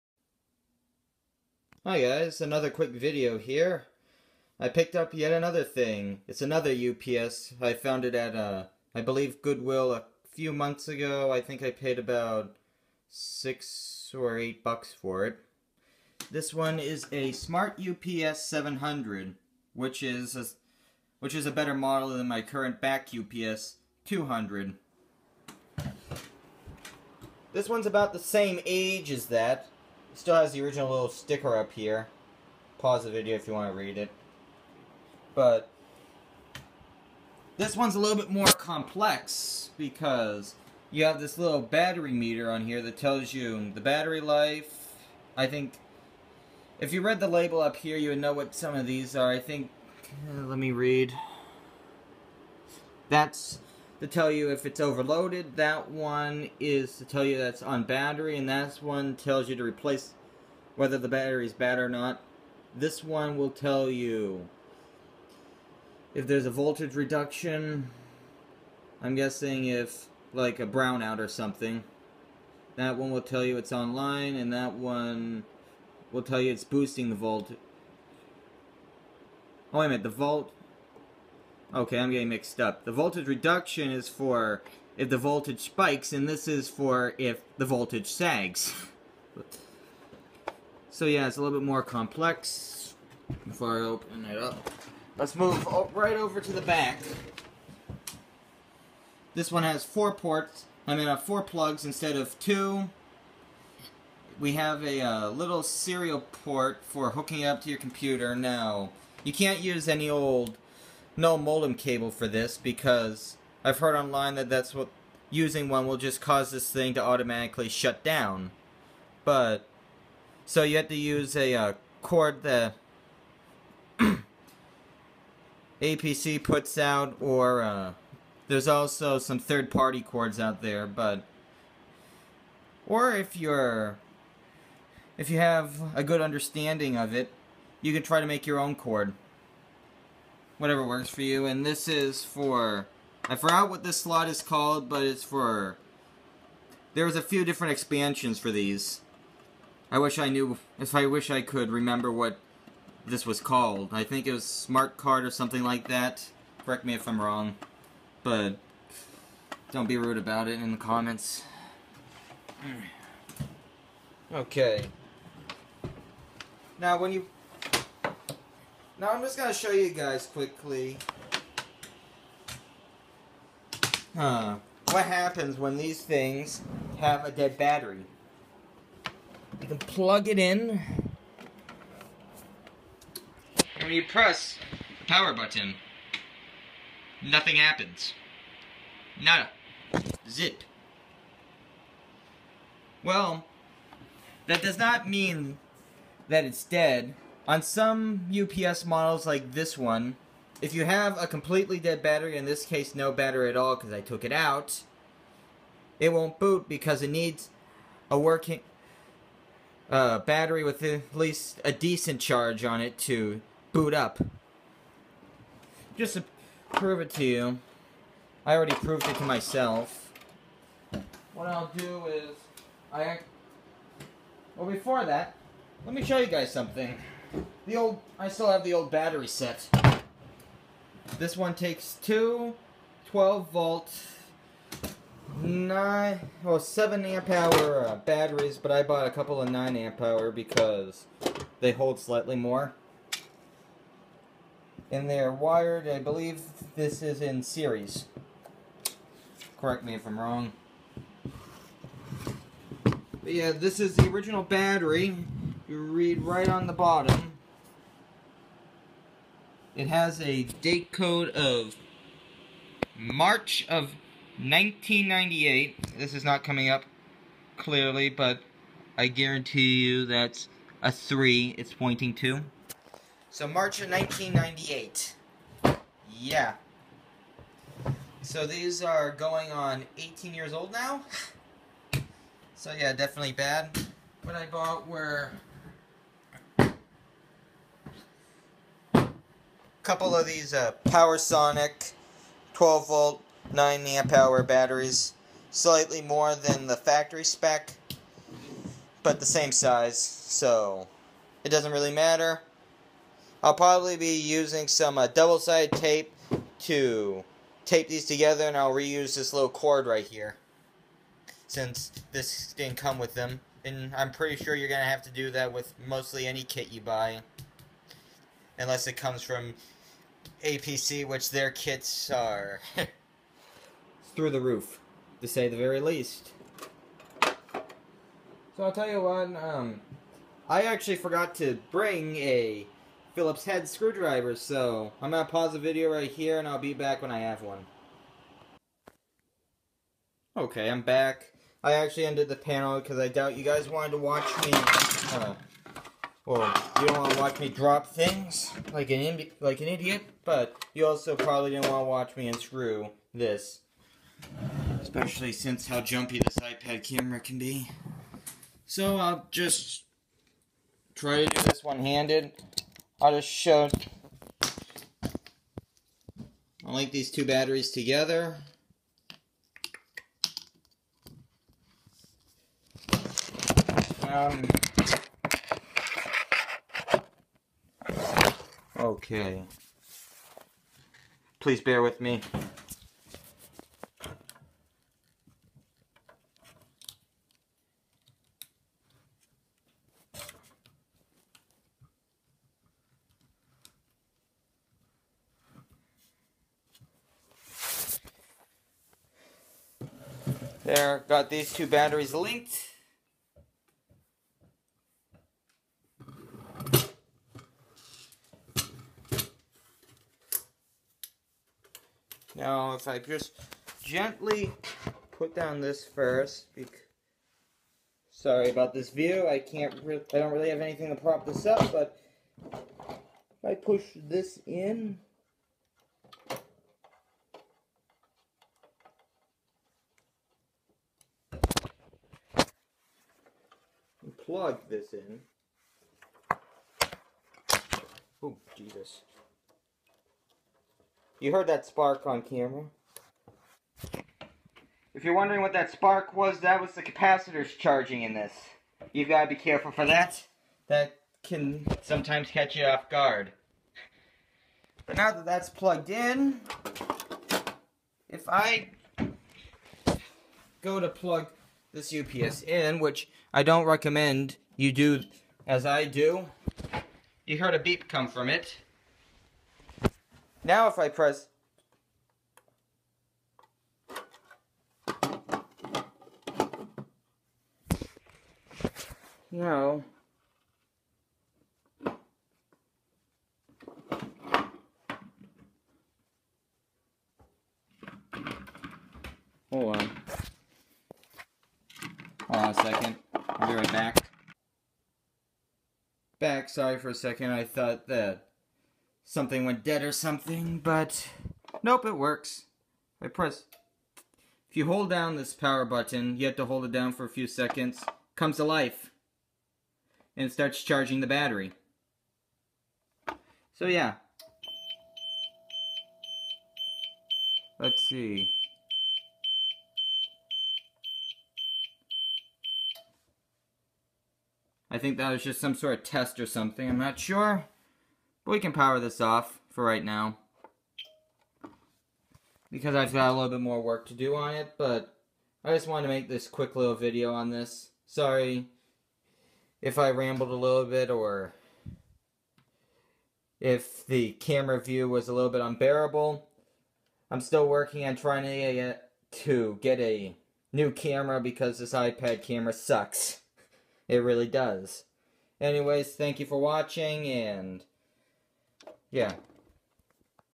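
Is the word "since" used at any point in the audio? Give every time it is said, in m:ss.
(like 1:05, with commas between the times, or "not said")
5:11, 5:55.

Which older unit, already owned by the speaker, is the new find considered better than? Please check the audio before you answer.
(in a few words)
Back UPS 200.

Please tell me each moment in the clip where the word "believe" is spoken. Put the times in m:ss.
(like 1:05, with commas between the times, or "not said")
0:09, 4:05.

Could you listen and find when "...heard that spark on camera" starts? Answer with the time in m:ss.
7:21.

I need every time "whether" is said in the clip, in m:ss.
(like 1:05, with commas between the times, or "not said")
1:00.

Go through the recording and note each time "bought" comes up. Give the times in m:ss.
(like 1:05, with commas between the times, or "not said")
3:58, 4:44.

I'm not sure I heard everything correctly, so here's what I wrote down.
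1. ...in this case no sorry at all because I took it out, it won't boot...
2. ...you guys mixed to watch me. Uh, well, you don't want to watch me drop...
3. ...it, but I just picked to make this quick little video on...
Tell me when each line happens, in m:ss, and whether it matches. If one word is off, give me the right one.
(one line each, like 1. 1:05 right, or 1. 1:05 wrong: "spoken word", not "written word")
1. 3:22 wrong: "battery", not "sorry"
2. 5:43 wrong: "wanted", not "mixed"
3. 8:54 wrong: "wanted", not "picked".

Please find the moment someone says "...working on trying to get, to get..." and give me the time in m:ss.
9:07.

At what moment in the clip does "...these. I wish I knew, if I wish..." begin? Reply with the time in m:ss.
2:28.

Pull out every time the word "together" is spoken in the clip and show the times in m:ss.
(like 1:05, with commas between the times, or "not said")
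5:08, 6:07.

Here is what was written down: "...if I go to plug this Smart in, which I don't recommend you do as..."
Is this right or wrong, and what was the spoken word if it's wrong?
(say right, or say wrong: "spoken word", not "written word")
wrong: "UPS", not "Smart".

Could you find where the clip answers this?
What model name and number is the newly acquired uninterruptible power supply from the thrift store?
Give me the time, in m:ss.
0:17.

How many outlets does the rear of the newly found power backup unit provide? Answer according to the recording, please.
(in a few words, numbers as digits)
4.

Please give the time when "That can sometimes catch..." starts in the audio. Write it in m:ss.
7:30.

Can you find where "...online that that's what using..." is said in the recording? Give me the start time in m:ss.
1:53.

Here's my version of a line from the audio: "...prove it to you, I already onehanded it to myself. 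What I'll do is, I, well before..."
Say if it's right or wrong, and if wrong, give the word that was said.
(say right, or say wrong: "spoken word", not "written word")
wrong: "proved", not "onehanded".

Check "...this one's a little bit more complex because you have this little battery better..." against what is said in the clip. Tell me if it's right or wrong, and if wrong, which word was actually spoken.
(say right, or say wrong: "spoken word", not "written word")
wrong: "meter", not "better".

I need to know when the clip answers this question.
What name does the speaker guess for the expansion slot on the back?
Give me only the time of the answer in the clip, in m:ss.
2:34.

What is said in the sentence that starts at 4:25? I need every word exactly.
This is not coming up clearly, but I guarantee you that's a 3 it's pointing to.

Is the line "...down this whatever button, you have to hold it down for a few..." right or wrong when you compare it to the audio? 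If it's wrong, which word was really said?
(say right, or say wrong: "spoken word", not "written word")
wrong: "power", not "whatever".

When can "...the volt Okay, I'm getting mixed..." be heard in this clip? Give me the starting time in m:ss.
1:20.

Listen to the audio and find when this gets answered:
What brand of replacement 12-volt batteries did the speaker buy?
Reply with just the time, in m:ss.
4:51.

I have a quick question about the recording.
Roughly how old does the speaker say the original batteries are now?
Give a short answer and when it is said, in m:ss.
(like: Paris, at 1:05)
18 years, at 4:39.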